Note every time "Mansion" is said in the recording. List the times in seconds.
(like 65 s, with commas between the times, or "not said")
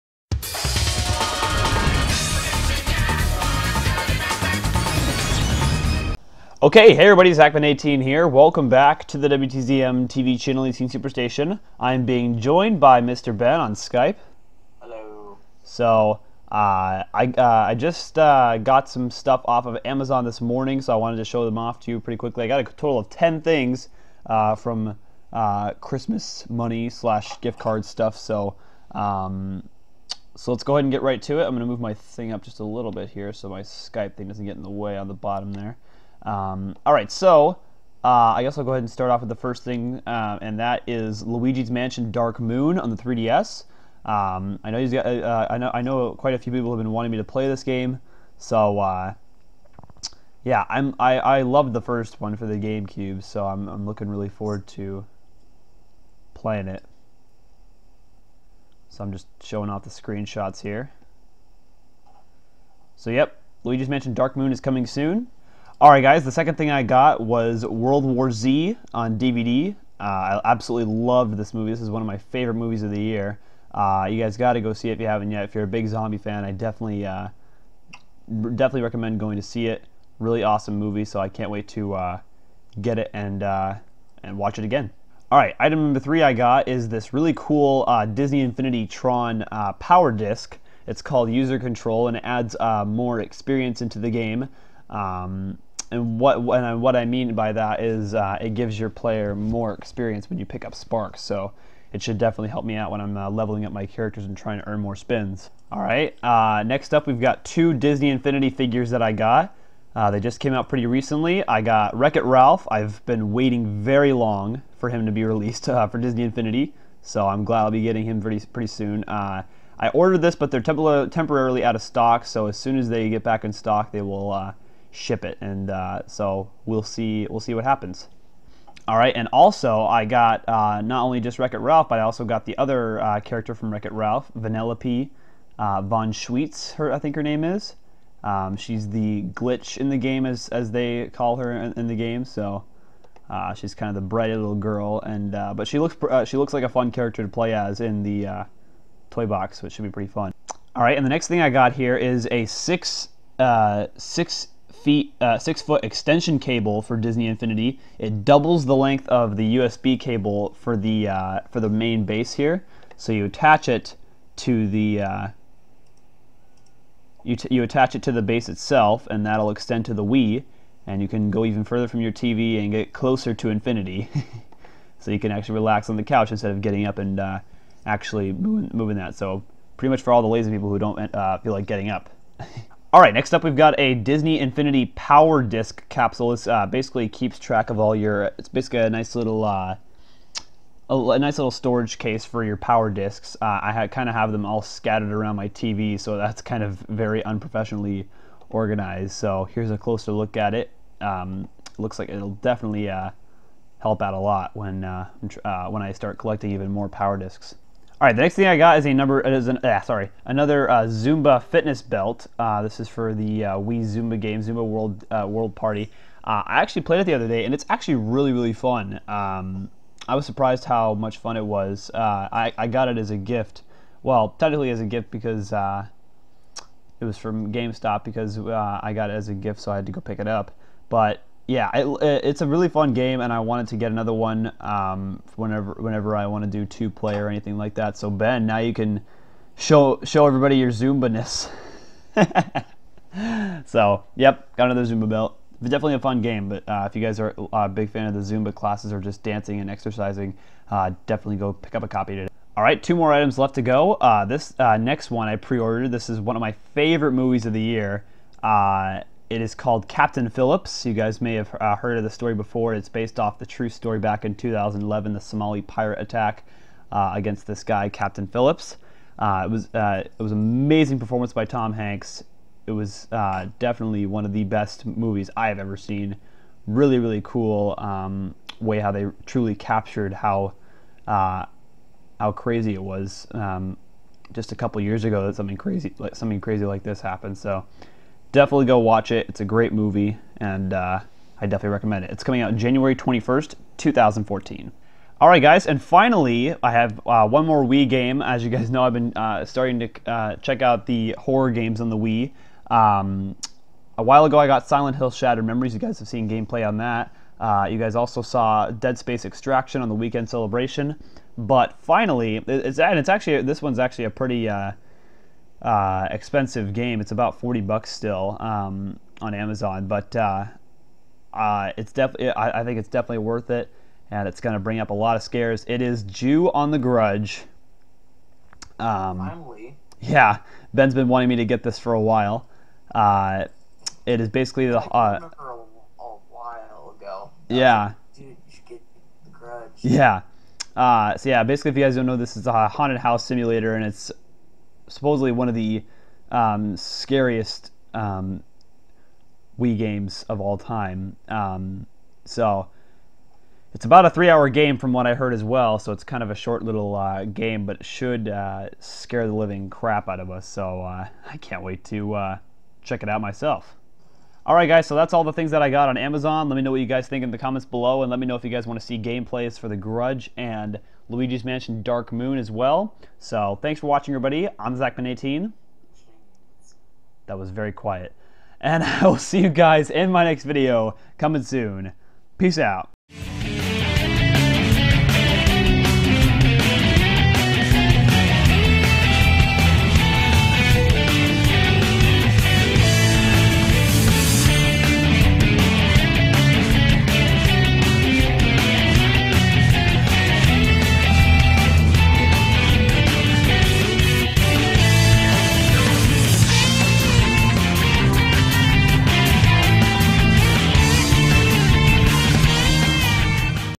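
41 s, 63 s, 371 s.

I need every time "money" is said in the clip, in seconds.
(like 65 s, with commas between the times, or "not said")
26 s.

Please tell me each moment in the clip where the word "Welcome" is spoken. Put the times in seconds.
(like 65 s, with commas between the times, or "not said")
8 s.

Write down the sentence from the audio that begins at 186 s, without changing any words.
This uh, basically keeps track of all your.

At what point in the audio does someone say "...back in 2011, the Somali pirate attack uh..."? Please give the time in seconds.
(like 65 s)
263 s.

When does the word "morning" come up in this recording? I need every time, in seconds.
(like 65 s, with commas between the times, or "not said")
20 s.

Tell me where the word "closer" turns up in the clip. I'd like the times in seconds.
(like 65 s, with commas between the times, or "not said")
172 s, 199 s.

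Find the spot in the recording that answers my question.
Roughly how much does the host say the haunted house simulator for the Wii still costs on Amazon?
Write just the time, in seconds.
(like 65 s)
317 s.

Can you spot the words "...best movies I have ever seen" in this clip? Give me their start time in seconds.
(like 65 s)
274 s.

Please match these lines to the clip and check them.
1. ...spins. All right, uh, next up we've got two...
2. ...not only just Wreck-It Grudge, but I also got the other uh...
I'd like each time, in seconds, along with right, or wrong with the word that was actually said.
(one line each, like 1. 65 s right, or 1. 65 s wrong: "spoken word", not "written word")
1. 104 s right
2. 130 s wrong: "Ralph", not "Grudge".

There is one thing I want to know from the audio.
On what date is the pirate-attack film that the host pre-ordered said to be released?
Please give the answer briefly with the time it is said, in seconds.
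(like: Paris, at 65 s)
January 21st, 2014, at 292 s.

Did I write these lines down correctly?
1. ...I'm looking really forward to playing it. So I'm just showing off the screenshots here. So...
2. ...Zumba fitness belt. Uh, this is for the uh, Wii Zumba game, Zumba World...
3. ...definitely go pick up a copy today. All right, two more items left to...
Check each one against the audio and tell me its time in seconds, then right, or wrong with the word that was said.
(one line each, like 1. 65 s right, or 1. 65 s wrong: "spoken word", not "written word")
1. 53 s right
2. 210 s right
3. 251 s right.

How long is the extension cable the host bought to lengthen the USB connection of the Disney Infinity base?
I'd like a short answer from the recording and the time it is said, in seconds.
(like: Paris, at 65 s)
6 feet, at 155 s.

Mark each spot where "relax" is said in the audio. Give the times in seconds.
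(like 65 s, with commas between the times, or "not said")
175 s.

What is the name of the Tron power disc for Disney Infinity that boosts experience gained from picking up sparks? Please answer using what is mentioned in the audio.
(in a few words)
User Control.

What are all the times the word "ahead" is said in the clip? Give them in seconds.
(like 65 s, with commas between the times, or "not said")
30 s, 38 s.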